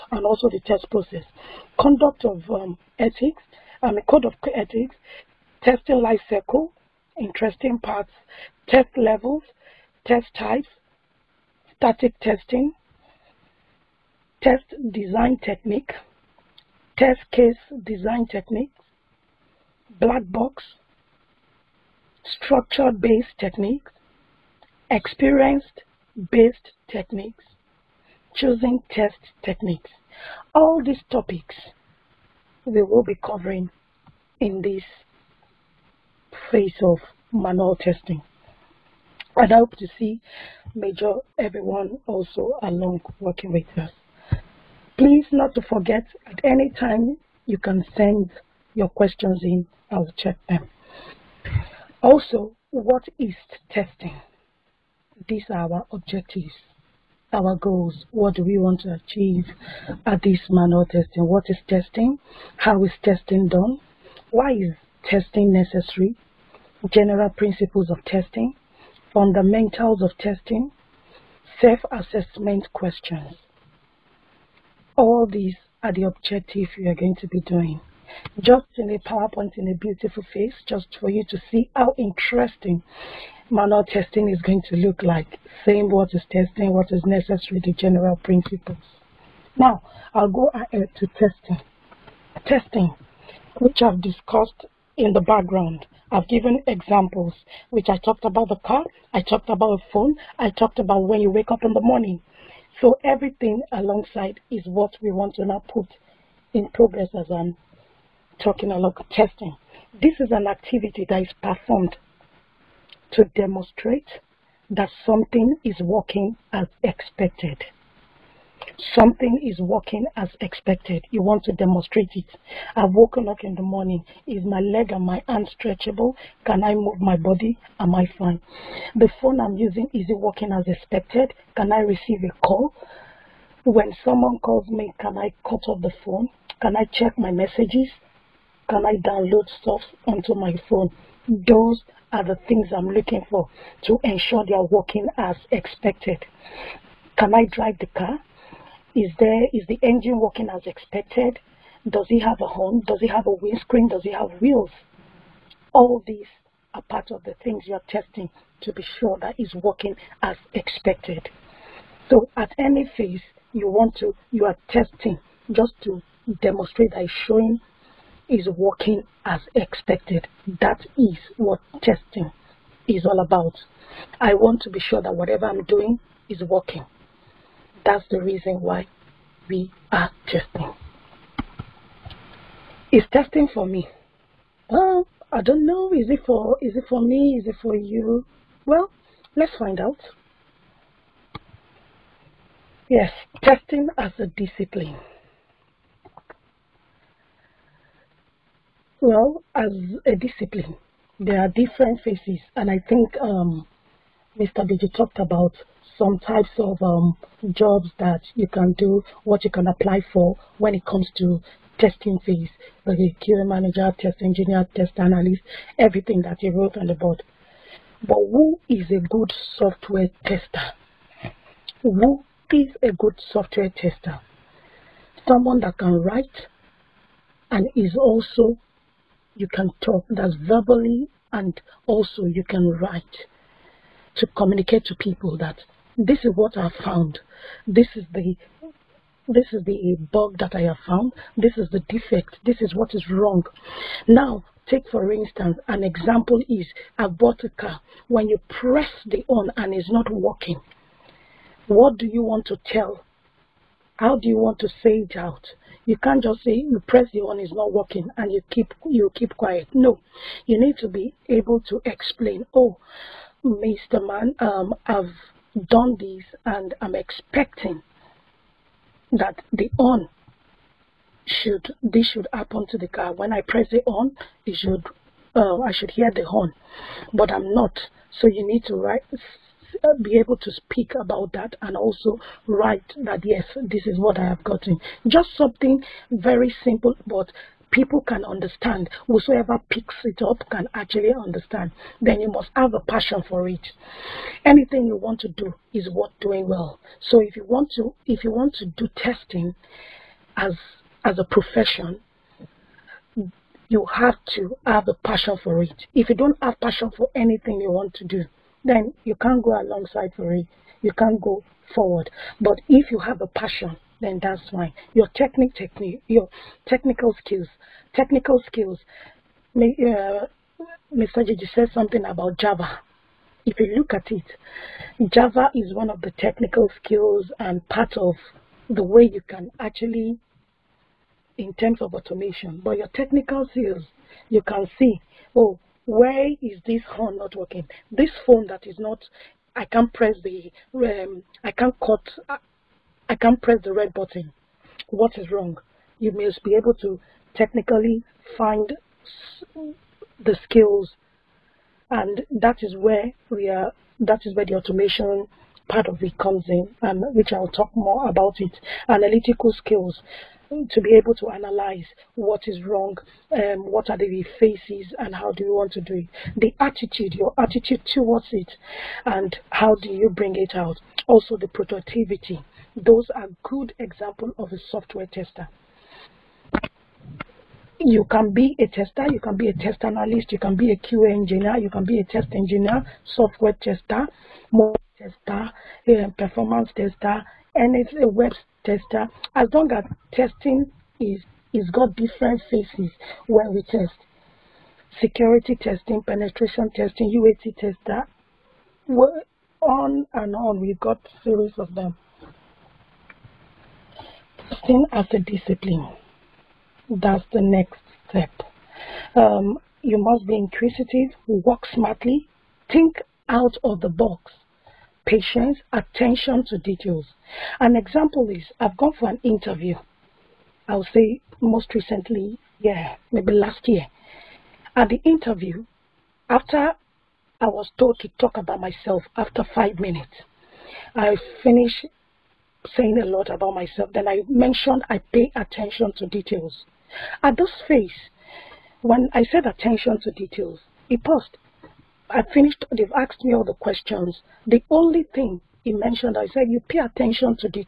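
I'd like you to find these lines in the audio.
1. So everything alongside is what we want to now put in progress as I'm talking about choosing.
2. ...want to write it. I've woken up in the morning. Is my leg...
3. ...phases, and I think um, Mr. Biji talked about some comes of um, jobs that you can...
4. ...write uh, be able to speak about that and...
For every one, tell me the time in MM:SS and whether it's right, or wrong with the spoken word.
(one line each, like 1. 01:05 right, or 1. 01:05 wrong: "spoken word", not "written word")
1. 01:42 wrong: "testing", not "choosing"
2. 02:01 wrong: "demonstrate", not "write"
3. 03:22 wrong: "types", not "comes"
4. 04:38 right.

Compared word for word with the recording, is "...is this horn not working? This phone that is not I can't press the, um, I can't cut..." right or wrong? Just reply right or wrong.
right.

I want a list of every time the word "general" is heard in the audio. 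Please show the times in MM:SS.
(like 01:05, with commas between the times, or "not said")
01:06, 01:27.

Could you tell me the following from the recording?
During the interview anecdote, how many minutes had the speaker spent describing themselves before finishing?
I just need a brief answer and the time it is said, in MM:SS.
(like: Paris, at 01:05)
5, at 07:09.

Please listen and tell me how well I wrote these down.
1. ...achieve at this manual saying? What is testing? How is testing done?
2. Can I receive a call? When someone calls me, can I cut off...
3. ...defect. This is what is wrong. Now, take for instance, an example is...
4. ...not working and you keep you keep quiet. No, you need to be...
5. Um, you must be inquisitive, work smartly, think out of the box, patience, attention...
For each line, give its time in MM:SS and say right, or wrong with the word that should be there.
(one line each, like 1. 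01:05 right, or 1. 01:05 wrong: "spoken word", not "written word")
1. 00:58 wrong: "testing", not "saying"
2. 02:11 right
3. 04:01 right
4. 04:17 right
5. 06:49 right.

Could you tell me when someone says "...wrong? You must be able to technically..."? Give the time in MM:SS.
05:45.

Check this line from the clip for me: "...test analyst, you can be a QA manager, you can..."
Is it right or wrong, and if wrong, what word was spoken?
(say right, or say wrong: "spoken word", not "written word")
wrong: "engineer", not "manager".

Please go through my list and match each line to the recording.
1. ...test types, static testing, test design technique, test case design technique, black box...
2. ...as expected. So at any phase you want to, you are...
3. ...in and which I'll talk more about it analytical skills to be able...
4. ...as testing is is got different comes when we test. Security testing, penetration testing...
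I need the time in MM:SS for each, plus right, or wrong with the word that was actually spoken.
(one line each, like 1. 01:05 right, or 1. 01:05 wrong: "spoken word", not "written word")
1. 00:10 right
2. 02:40 right
3. 05:56 right
4. 06:29 wrong: "phases", not "comes".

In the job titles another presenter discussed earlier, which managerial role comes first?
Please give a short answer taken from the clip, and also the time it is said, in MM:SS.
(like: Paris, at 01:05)
QA manager, at 03:32.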